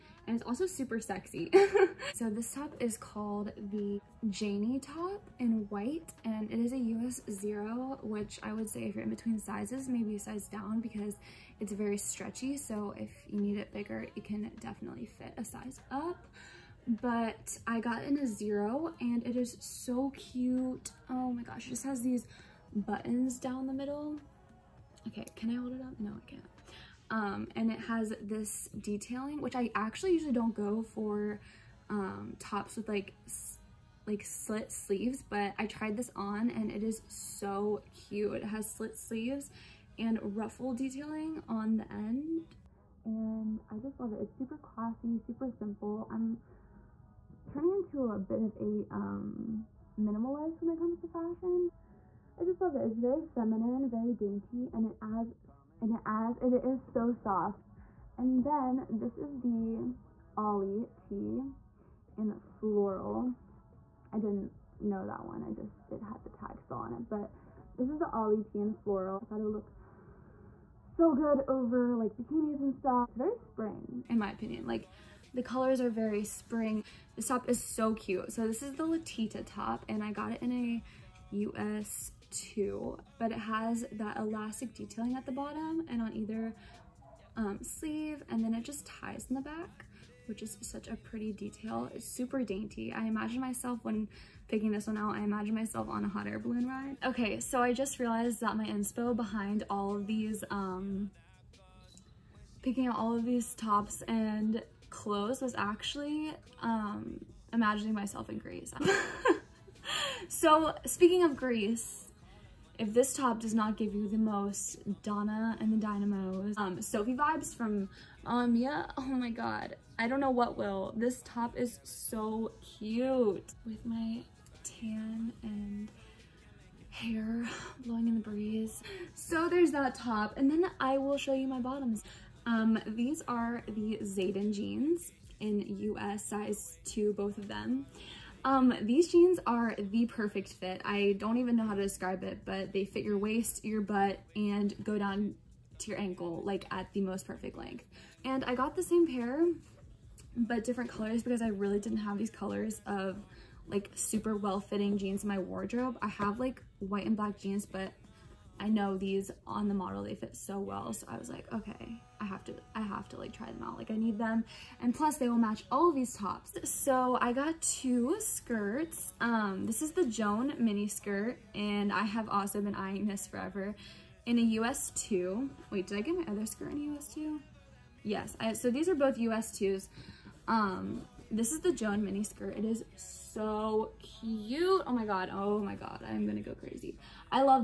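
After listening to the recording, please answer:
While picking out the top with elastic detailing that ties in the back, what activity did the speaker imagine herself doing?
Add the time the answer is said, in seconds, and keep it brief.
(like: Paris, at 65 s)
hot air balloon ride, at 96 s.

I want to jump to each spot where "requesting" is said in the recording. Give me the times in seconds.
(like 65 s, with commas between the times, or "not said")
not said.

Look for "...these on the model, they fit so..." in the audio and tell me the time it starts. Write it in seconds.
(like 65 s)
158 s.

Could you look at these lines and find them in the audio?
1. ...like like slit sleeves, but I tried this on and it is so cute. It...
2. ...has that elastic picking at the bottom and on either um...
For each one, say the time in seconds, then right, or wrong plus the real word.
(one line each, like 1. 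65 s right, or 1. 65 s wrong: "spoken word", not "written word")
1. 32 s right
2. 83 s wrong: "detailing", not "picking".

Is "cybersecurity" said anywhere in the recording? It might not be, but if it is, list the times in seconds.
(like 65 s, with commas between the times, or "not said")
not said.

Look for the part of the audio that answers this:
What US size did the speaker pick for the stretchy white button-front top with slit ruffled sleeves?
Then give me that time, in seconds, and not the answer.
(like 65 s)
6 s.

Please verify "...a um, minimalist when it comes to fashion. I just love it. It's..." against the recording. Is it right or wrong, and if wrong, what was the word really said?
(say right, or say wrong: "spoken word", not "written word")
right.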